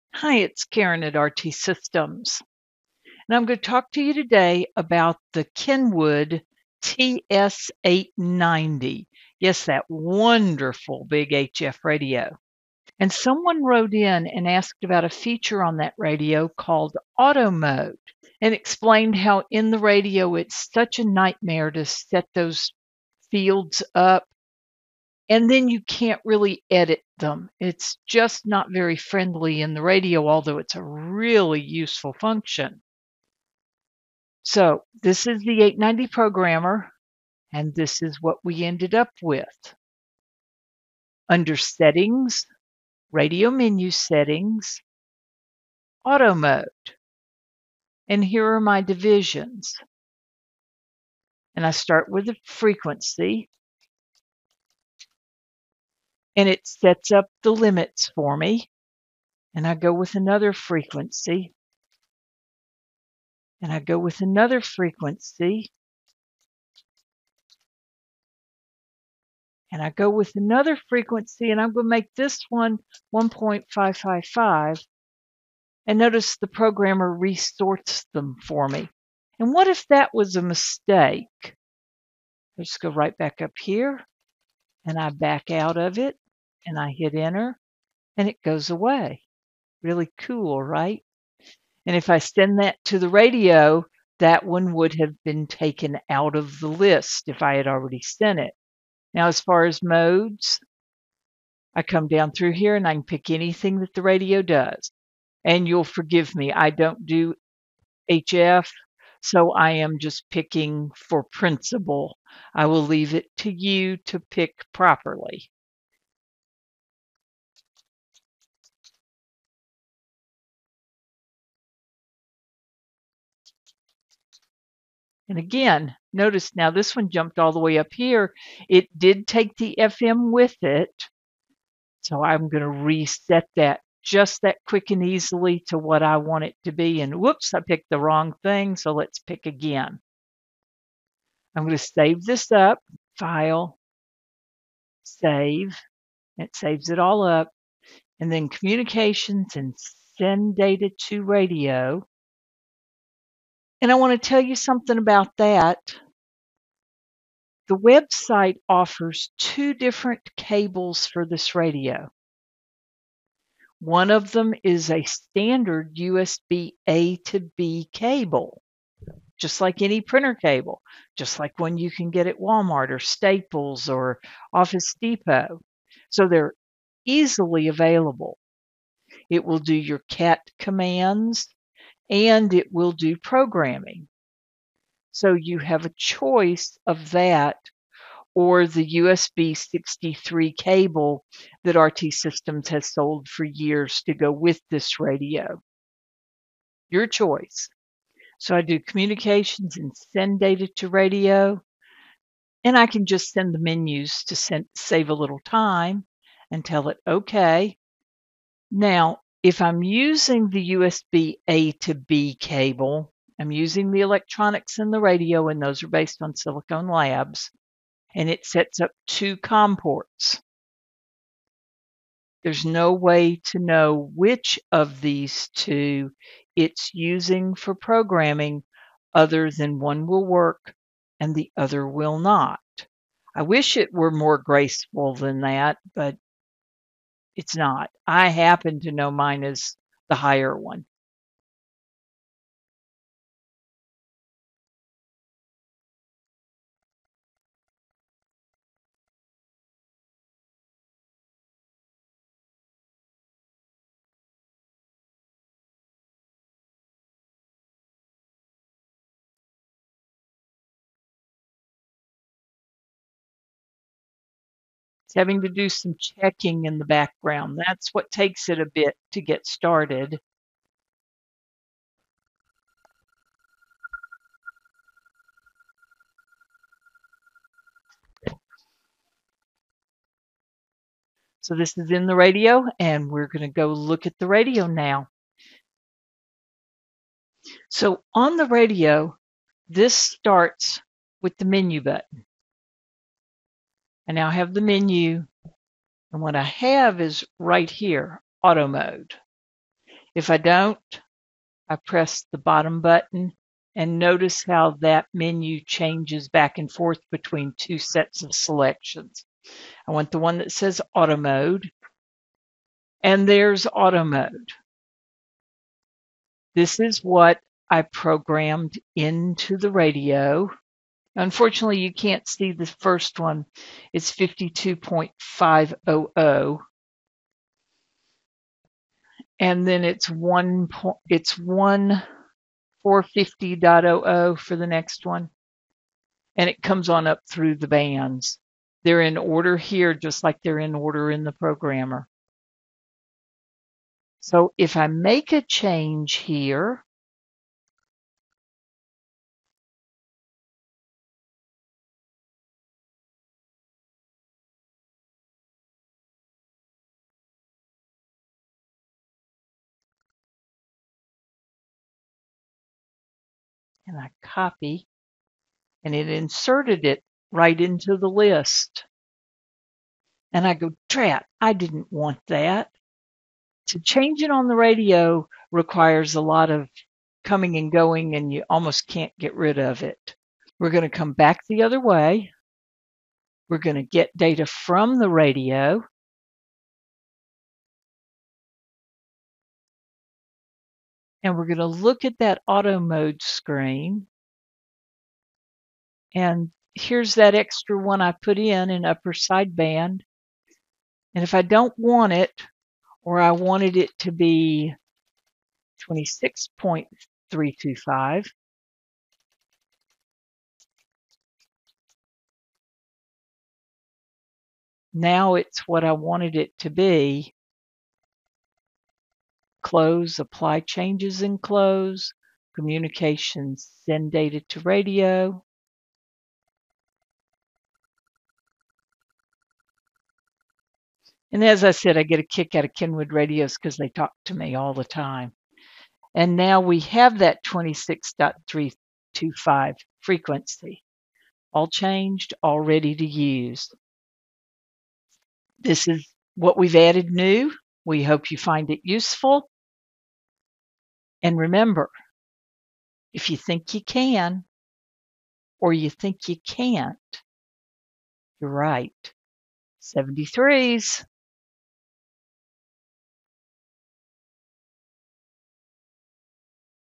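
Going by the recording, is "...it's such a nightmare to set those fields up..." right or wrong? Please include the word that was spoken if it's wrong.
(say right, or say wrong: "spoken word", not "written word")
right.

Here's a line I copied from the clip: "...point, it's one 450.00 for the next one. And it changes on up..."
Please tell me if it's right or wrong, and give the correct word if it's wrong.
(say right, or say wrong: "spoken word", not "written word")
wrong: "comes", not "changes".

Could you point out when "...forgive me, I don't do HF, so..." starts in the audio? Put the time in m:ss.
1:45.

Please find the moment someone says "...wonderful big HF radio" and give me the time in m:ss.
0:09.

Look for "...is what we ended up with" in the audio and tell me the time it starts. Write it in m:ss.
0:38.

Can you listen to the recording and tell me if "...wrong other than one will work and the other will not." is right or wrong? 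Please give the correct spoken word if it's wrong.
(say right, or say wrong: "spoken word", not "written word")
wrong: "programming", not "wrong".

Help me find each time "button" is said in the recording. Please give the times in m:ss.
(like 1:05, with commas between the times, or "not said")
4:51, 5:02.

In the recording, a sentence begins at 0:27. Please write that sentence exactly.
It's just not very friendly in the radio, although it's a really useful function.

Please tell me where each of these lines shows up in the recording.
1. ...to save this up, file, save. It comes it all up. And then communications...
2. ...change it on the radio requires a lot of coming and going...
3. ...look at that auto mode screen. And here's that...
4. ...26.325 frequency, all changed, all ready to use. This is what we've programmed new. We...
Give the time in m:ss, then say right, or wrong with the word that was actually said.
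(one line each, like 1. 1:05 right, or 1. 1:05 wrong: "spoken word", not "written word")
1. 2:21 wrong: "saves", not "comes"
2. 6:13 right
3. 6:31 right
4. 7:17 wrong: "added", not "programmed".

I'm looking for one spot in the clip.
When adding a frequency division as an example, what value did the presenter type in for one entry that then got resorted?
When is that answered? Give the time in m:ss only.
1:13.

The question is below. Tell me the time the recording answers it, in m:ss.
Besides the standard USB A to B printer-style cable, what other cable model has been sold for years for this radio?
3:08.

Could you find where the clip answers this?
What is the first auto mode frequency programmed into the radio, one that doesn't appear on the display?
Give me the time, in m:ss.
5:24.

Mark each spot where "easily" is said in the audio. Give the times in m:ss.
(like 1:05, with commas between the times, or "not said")
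2:15, 2:57.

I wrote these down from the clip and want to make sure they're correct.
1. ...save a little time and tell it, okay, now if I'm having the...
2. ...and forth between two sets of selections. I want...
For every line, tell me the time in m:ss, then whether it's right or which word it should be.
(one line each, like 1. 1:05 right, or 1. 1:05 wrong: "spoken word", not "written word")
1. 3:24 wrong: "using", not "having"
2. 5:06 right.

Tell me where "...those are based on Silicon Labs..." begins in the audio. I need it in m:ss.
3:35.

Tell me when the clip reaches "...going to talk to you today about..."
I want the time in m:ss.
0:03.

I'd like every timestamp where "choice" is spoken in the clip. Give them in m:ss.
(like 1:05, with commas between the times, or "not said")
3:05, 3:17.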